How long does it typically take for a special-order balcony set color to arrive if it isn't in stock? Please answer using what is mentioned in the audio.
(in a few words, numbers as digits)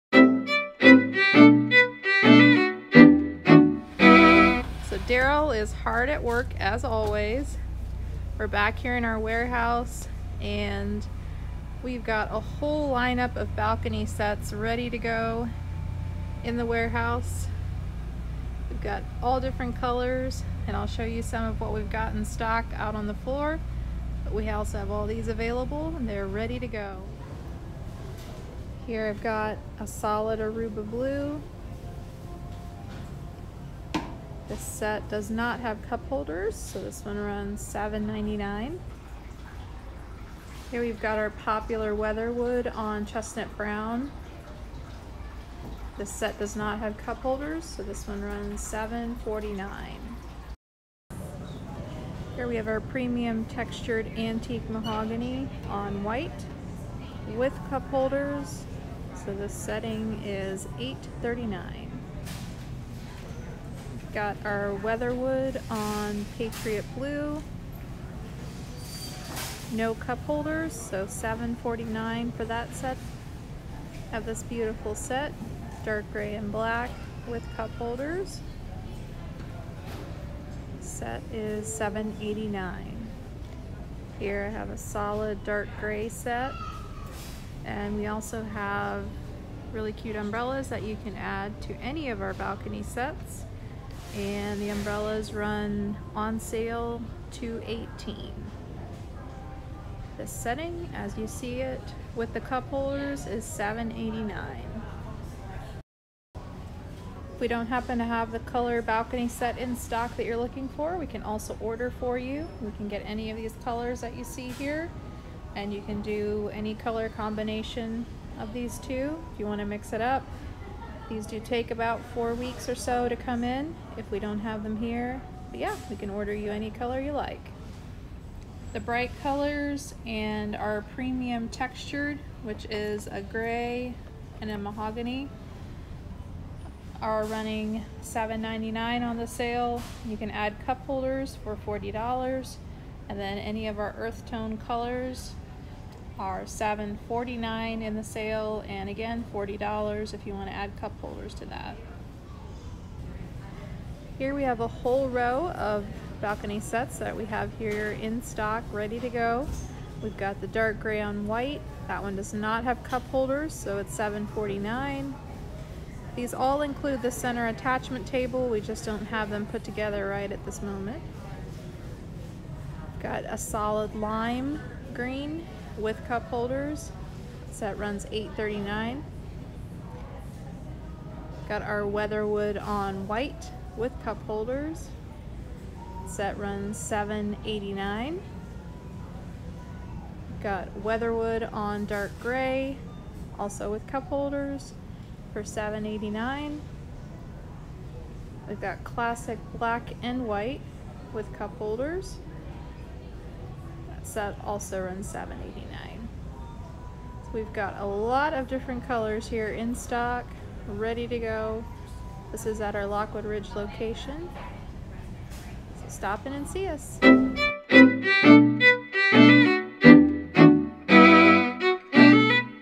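about 4 weeks.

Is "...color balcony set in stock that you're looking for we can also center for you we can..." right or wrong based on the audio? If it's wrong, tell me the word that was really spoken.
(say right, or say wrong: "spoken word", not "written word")
wrong: "order", not "center".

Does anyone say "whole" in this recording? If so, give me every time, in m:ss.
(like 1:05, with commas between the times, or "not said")
0:12, 2:34.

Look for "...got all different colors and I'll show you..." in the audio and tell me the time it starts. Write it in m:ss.
0:18.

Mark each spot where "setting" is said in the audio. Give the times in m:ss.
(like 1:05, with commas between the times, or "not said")
0:59, 1:40.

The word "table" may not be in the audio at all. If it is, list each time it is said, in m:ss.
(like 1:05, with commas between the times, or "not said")
2:48.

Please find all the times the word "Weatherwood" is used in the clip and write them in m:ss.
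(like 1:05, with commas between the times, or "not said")
0:41, 1:04, 3:01, 3:10.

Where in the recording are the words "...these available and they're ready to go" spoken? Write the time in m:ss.
0:25.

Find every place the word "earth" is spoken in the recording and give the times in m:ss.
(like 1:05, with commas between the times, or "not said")
2:23.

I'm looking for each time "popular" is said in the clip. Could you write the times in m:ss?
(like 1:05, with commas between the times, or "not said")
0:41.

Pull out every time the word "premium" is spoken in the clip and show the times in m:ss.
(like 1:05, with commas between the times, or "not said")
0:52, 2:10.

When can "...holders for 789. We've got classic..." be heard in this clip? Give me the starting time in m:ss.
3:14.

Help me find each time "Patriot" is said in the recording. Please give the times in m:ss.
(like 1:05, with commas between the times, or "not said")
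1:06.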